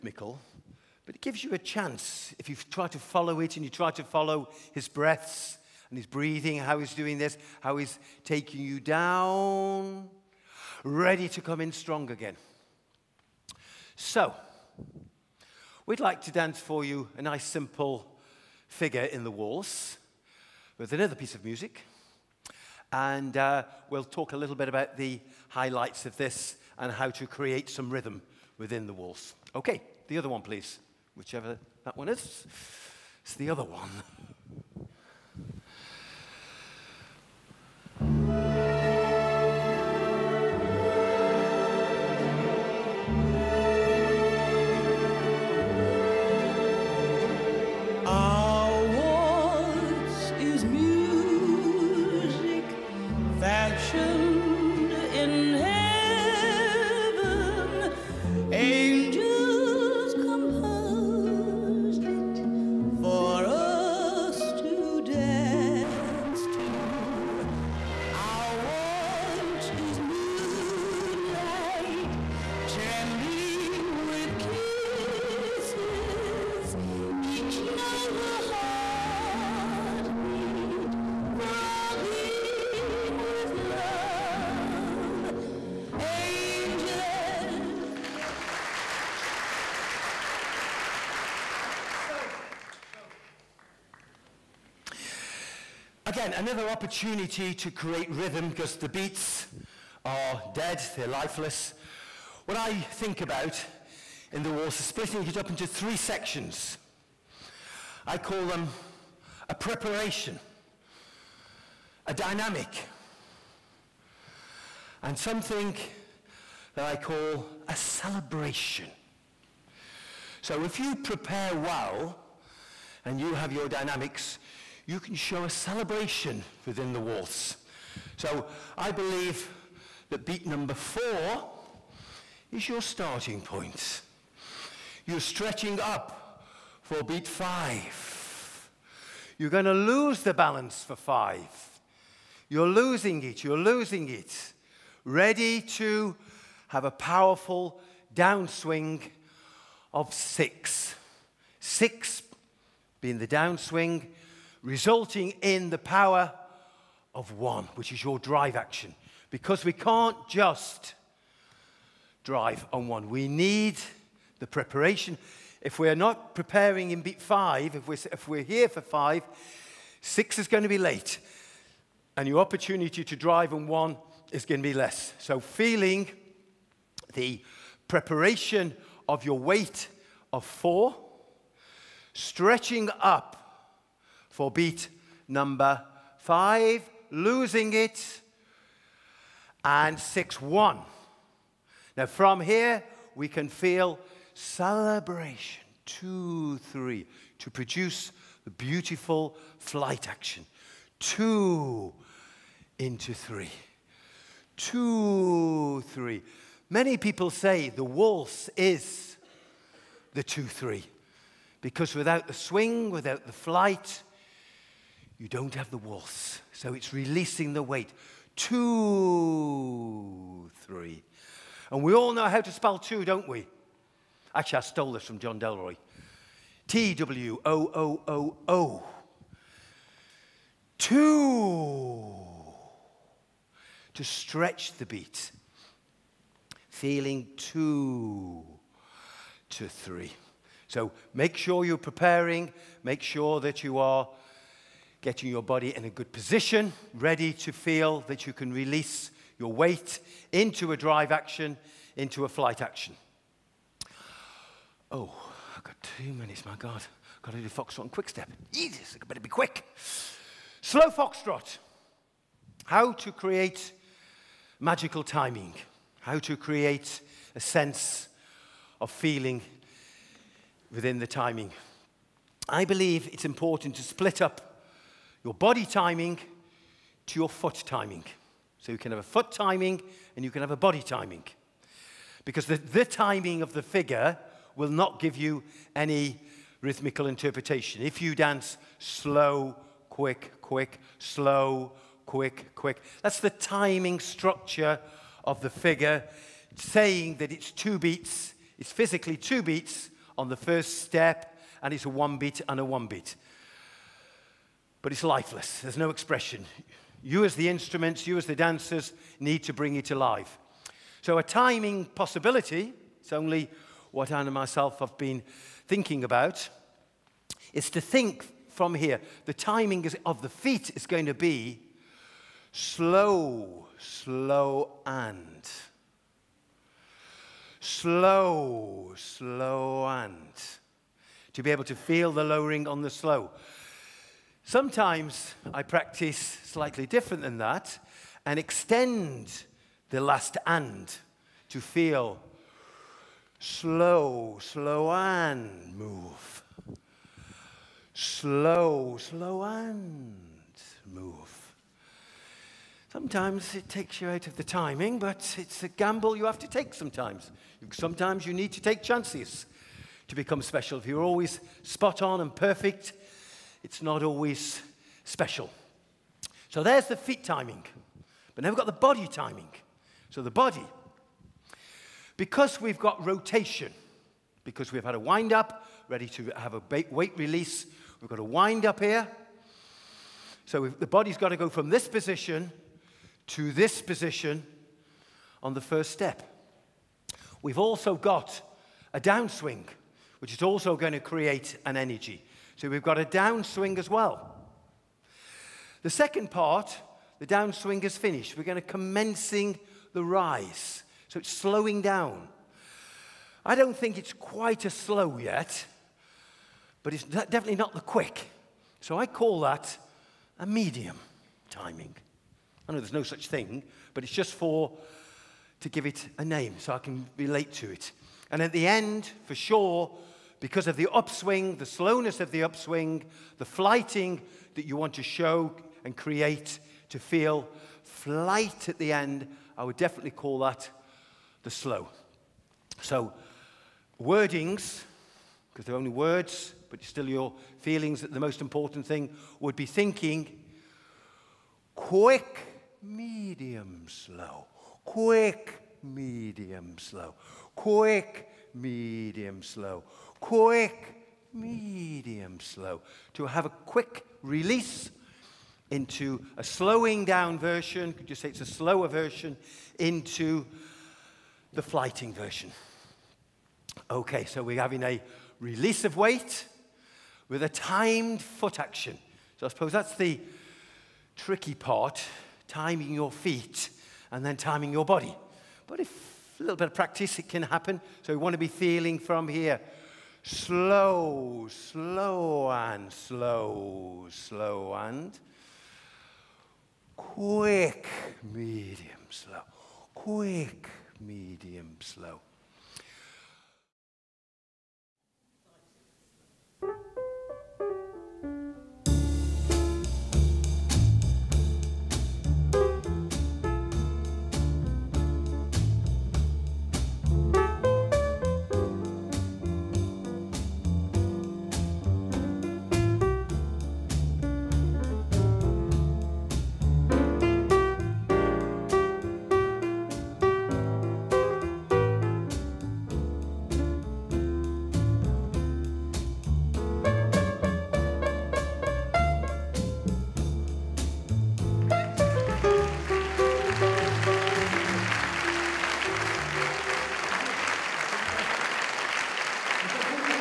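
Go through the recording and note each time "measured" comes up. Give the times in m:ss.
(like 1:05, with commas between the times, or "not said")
not said.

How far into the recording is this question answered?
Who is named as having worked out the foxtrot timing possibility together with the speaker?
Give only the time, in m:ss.
5:14.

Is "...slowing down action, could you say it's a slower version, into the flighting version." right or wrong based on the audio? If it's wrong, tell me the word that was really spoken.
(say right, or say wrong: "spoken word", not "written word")
wrong: "version", not "action".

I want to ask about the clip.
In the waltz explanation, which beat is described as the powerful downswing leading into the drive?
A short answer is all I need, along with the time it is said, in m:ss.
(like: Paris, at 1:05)
6, at 2:31.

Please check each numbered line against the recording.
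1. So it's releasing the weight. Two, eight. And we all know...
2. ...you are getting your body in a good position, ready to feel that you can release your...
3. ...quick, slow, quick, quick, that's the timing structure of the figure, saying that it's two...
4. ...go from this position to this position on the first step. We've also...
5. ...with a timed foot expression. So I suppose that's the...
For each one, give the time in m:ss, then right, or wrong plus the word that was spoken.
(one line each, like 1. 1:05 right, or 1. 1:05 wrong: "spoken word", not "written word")
1. 3:36 wrong: "three", not "eight"
2. 4:03 right
3. 4:50 right
4. 6:21 right
5. 7:47 wrong: "action", not "expression".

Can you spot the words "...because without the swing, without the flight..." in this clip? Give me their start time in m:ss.
3:31.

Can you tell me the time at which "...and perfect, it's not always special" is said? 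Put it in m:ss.
6:02.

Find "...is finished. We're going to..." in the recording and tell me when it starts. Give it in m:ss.
6:37.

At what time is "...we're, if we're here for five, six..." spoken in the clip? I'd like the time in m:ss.
2:47.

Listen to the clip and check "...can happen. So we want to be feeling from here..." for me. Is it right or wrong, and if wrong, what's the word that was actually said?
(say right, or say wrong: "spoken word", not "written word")
right.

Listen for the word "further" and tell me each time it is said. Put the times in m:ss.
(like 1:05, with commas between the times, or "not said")
not said.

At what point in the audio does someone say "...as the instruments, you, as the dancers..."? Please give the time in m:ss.
5:07.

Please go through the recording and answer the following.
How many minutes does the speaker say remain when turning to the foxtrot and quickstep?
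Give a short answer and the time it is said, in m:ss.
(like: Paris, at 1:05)
2, at 4:15.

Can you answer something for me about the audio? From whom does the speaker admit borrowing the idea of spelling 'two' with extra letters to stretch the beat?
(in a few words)
John Delroy.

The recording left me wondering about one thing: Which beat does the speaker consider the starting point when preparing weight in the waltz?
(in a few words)
4.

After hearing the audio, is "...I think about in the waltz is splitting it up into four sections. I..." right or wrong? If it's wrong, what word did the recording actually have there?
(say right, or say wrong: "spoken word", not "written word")
wrong: "three", not "four".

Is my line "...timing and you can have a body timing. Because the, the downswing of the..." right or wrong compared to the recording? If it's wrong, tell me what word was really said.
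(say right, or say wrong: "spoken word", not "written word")
wrong: "timing", not "downswing".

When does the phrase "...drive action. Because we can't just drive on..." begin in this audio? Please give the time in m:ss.
2:38.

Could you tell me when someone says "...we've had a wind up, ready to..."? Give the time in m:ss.
6:14.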